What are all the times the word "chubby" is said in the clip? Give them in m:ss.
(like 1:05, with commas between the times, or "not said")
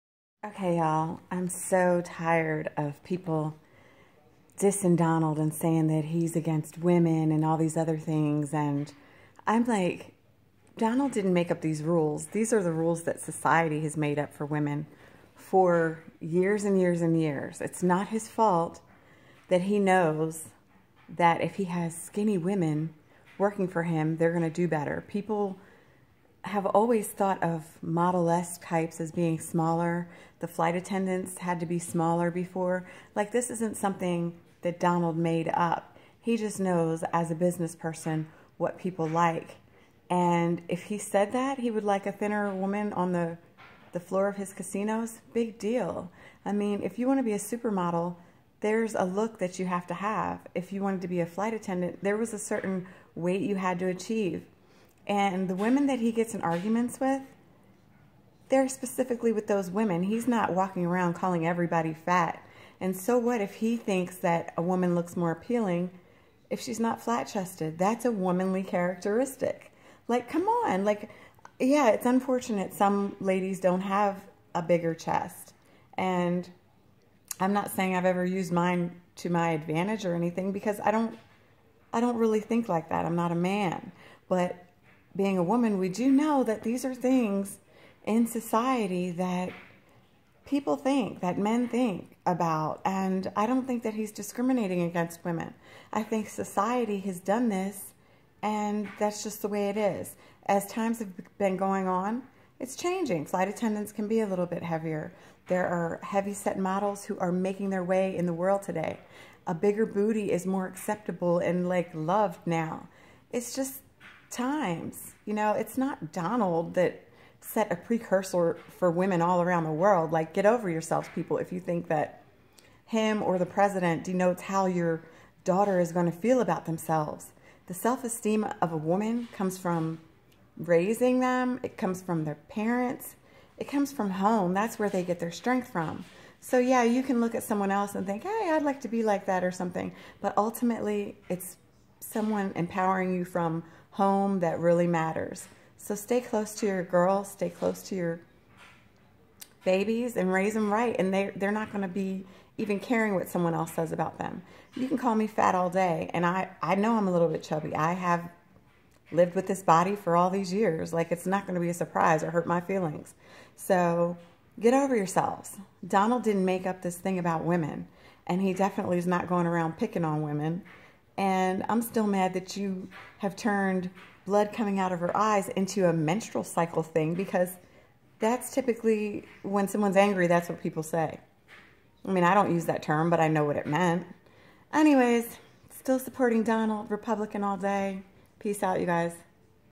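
2:37.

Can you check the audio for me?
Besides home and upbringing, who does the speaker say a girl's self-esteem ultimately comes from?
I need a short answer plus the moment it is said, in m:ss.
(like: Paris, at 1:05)
parents, at 2:12.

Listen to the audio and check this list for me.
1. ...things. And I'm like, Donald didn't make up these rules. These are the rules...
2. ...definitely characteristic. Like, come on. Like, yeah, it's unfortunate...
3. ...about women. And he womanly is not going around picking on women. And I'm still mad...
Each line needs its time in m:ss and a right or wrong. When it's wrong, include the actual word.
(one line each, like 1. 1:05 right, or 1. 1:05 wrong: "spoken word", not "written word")
1. 0:07 right
2. 1:08 wrong: "womanly", not "definitely"
3. 2:47 wrong: "definitely", not "womanly".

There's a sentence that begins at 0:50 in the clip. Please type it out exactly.
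If you wanted to be a flight attendant, there was a certain weight you had to achieve.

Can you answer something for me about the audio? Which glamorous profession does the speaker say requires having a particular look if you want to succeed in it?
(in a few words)
supermodel.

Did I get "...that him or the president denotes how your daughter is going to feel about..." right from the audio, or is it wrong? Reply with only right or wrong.
right.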